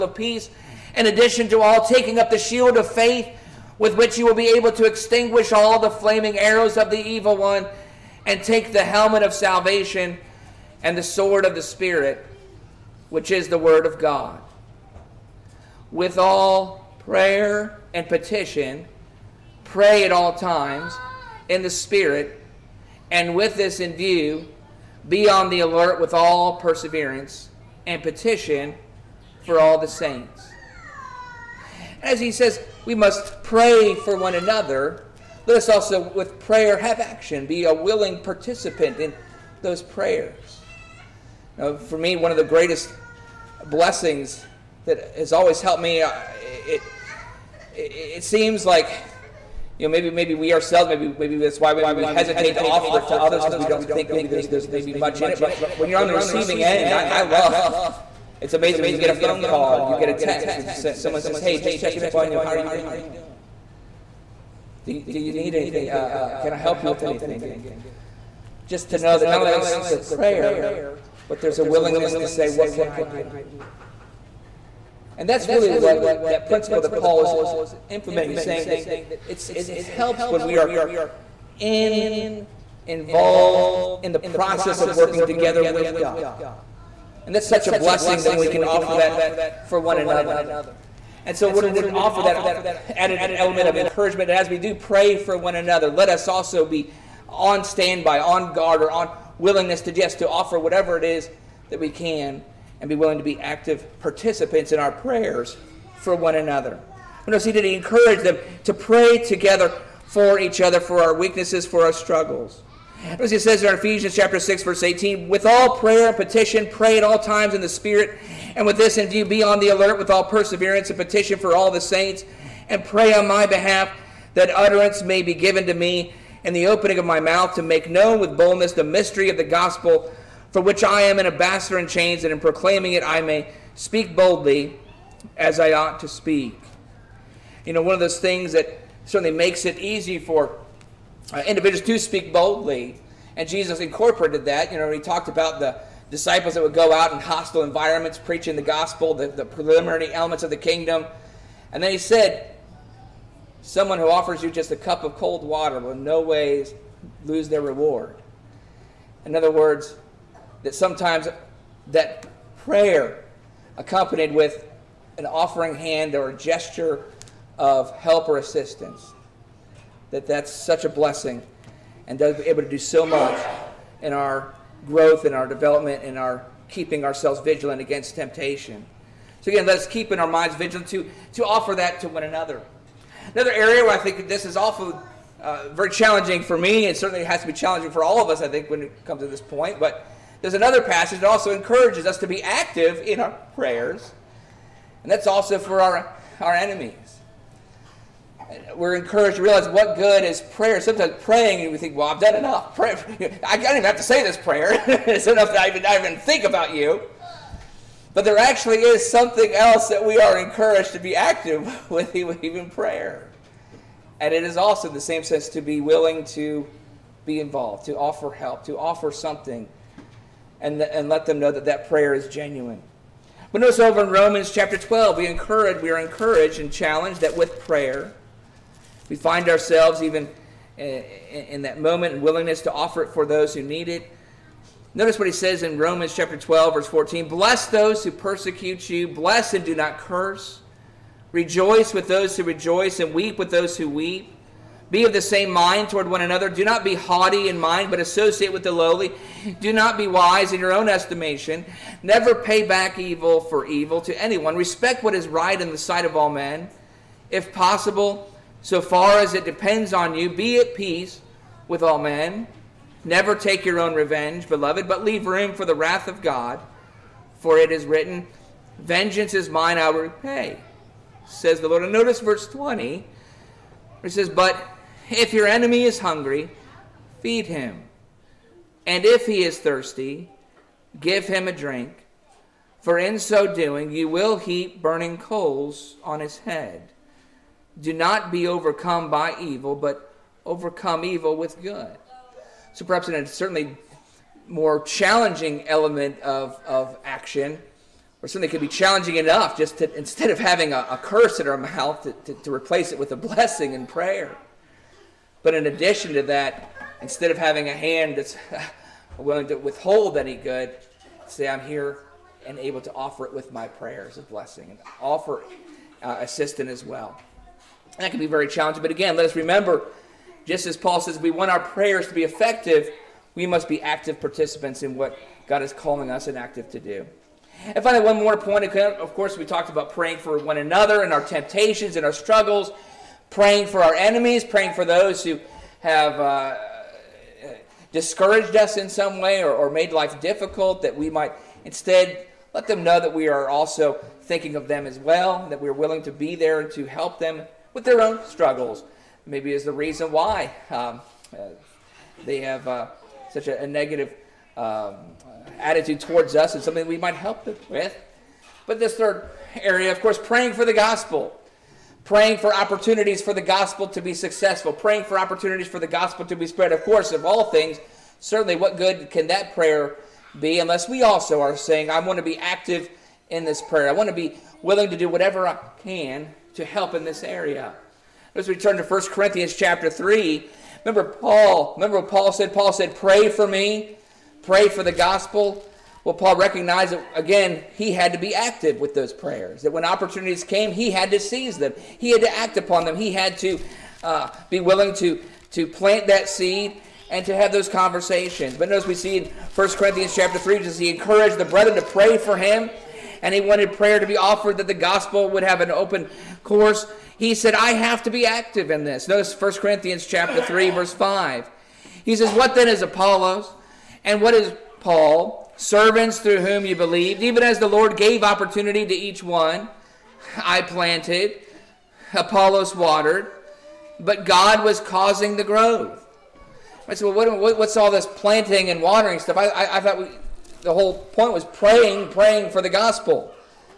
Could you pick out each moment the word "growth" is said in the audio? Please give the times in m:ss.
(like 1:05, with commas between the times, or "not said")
2:54, 7:05.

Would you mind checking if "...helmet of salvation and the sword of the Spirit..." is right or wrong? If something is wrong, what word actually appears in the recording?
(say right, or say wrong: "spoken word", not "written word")
right.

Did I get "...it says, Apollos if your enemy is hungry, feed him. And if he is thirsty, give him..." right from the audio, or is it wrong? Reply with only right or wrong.
wrong.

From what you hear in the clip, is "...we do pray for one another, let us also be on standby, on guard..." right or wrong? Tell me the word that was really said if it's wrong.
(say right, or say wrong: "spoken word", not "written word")
right.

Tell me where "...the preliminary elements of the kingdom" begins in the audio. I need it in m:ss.
2:29.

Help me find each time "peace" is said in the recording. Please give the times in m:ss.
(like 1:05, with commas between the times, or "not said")
0:00, 4:20.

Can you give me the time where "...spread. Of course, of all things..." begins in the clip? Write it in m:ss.
6:06.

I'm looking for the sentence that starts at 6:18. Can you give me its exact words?
Let's return to 1 Corinthians chapter 3.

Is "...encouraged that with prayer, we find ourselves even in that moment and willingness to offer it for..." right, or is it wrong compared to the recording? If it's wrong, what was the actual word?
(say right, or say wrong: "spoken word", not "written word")
wrong: "challenged", not "encouraged".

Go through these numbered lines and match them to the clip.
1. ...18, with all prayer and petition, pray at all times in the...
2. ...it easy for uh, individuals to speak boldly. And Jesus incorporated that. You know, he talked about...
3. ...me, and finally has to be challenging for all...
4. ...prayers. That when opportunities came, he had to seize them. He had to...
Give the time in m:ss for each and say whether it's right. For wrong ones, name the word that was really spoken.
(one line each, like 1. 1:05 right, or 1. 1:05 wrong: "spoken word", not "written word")
1. 1:54 right
2. 2:19 right
3. 3:06 wrong: "certainly", not "finally"
4. 6:29 right.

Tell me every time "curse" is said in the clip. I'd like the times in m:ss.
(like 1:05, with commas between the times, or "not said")
3:59, 5:01.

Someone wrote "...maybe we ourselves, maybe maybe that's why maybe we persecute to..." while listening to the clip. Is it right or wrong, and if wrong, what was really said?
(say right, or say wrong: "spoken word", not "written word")
wrong: "hesitate", not "persecute".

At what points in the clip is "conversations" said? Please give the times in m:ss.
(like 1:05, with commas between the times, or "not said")
6:37.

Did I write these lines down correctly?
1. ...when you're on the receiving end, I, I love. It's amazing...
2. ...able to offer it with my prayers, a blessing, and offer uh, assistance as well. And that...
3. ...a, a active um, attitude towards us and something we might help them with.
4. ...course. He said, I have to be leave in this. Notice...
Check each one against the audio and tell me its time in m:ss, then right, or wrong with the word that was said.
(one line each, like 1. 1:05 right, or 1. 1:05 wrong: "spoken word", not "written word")
1. 0:55 right
2. 5:12 right
3. 5:53 wrong: "negative", not "active"
4. 6:46 wrong: "active", not "leave".